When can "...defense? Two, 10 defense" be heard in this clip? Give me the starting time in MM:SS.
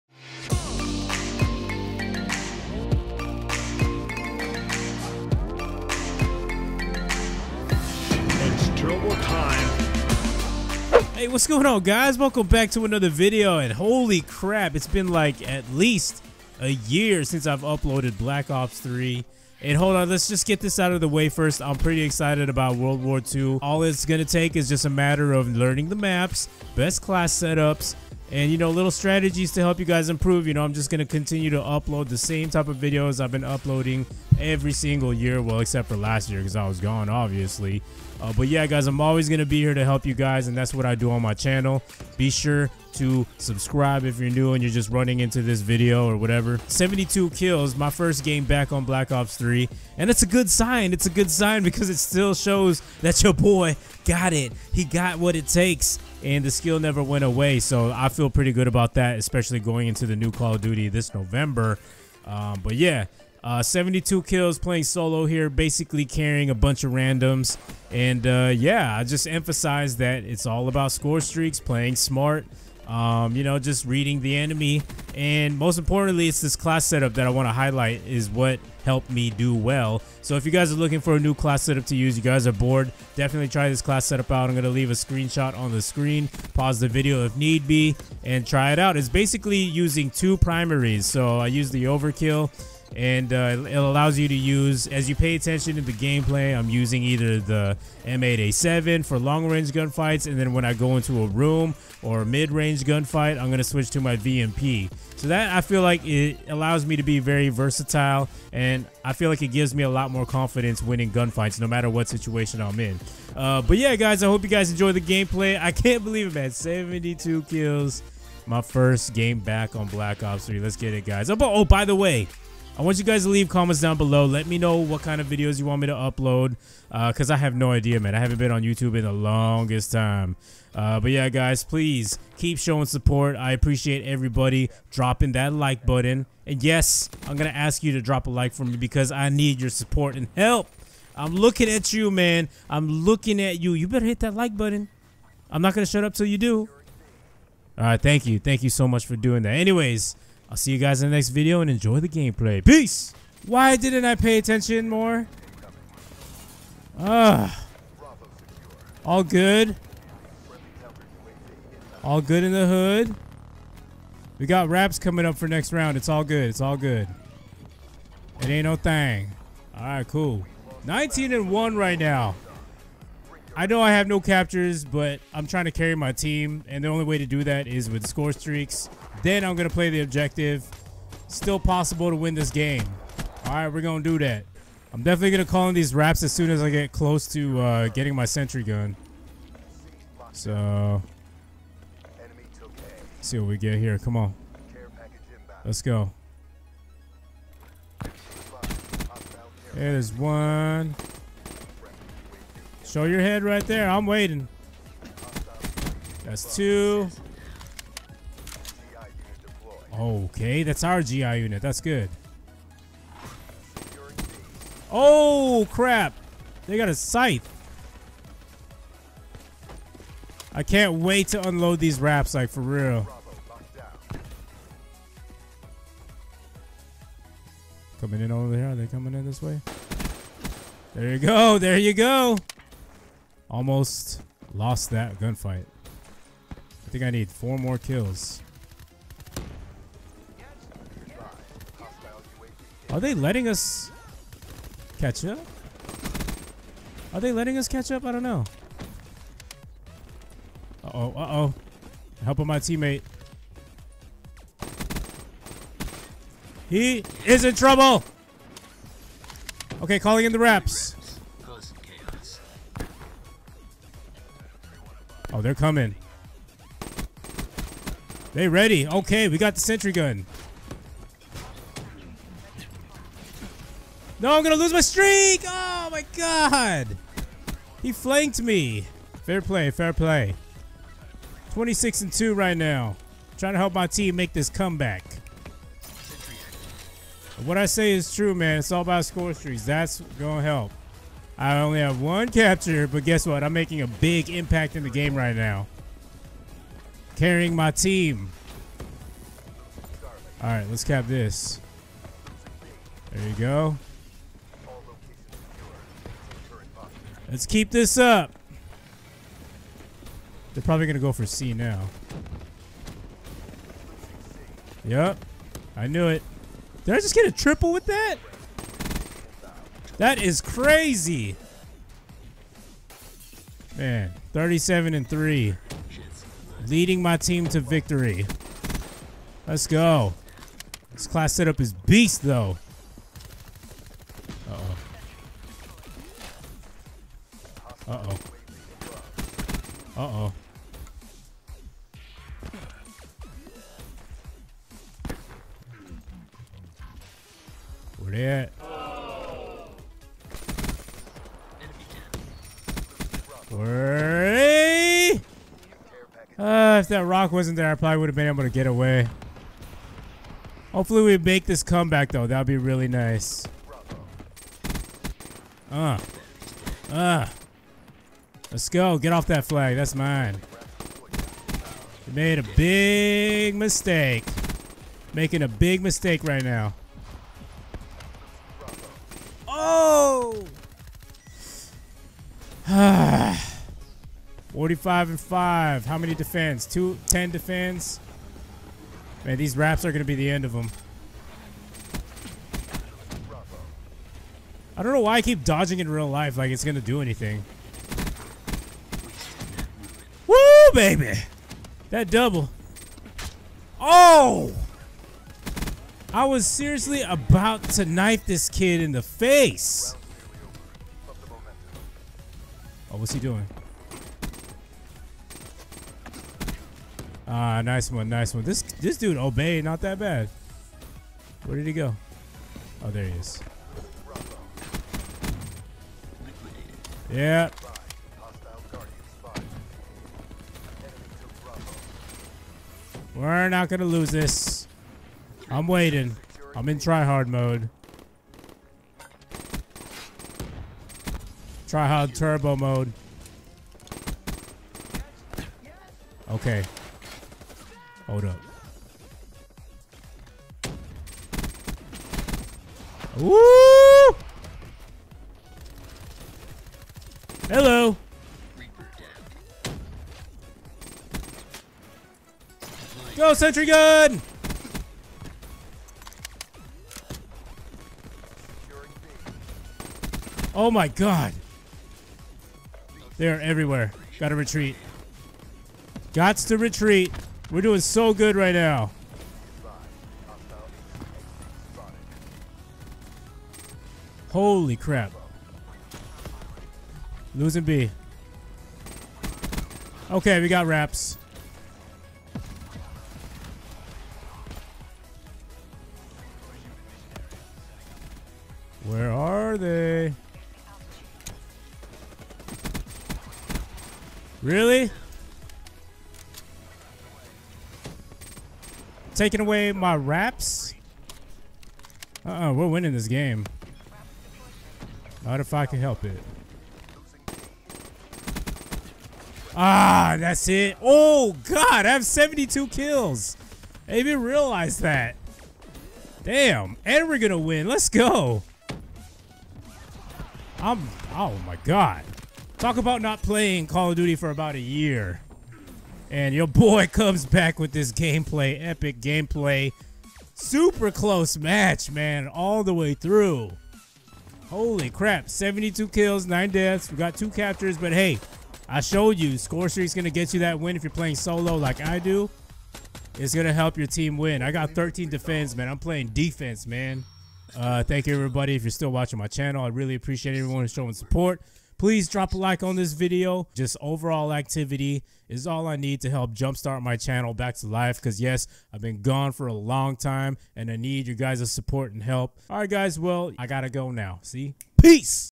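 06:26.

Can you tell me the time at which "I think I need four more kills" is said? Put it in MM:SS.
03:56.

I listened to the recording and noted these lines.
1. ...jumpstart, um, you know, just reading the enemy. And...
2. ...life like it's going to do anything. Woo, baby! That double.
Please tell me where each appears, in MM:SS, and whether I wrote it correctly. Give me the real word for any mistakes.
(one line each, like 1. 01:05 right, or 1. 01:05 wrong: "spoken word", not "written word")
1. 01:11 wrong: "smart", not "jumpstart"
2. 06:36 right.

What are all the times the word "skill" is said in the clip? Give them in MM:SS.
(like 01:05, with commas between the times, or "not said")
00:56.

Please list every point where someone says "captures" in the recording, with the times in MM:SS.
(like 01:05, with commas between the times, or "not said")
02:54, 04:52, 09:07.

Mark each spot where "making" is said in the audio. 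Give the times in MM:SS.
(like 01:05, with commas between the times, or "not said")
04:53, 06:15.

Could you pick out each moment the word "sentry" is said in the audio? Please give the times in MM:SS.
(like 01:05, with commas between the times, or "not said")
03:08, 04:29, 07:43.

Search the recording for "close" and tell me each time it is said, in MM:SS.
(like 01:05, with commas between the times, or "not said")
03:06, 09:00.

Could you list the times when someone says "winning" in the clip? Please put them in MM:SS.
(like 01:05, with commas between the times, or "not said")
01:50, 08:32.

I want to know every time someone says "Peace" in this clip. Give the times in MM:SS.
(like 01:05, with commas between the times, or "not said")
02:32, 09:34.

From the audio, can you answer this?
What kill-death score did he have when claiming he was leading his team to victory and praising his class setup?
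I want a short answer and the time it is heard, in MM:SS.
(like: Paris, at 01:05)
37 and 3, at 05:24.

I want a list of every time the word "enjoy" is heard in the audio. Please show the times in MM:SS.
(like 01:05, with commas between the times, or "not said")
01:54, 02:31.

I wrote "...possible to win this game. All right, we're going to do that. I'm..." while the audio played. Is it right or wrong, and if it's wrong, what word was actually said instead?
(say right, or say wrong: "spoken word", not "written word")
right.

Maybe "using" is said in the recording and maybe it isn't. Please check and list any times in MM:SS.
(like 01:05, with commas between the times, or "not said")
01:29, 01:36.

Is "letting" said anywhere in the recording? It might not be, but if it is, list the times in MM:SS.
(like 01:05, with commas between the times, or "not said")
04:03, 04:07.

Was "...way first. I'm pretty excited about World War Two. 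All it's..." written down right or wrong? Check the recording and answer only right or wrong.
right.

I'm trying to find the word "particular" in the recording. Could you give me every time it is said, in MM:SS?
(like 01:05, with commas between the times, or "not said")
not said.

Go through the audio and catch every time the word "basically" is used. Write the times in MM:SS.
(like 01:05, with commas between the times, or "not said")
01:05, 01:29.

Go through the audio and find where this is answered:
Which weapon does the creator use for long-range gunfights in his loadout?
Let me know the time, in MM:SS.
01:38.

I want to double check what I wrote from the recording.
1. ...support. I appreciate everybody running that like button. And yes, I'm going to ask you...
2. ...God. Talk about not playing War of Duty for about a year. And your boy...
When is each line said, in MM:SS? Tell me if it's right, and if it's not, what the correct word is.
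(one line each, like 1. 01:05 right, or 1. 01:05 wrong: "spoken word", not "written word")
1. 02:12 wrong: "dropping", not "running"
2. 08:51 wrong: "Call", not "War".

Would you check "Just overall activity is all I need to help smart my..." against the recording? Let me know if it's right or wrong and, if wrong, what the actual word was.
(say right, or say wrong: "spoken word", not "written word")
wrong: "jumpstart", not "smart".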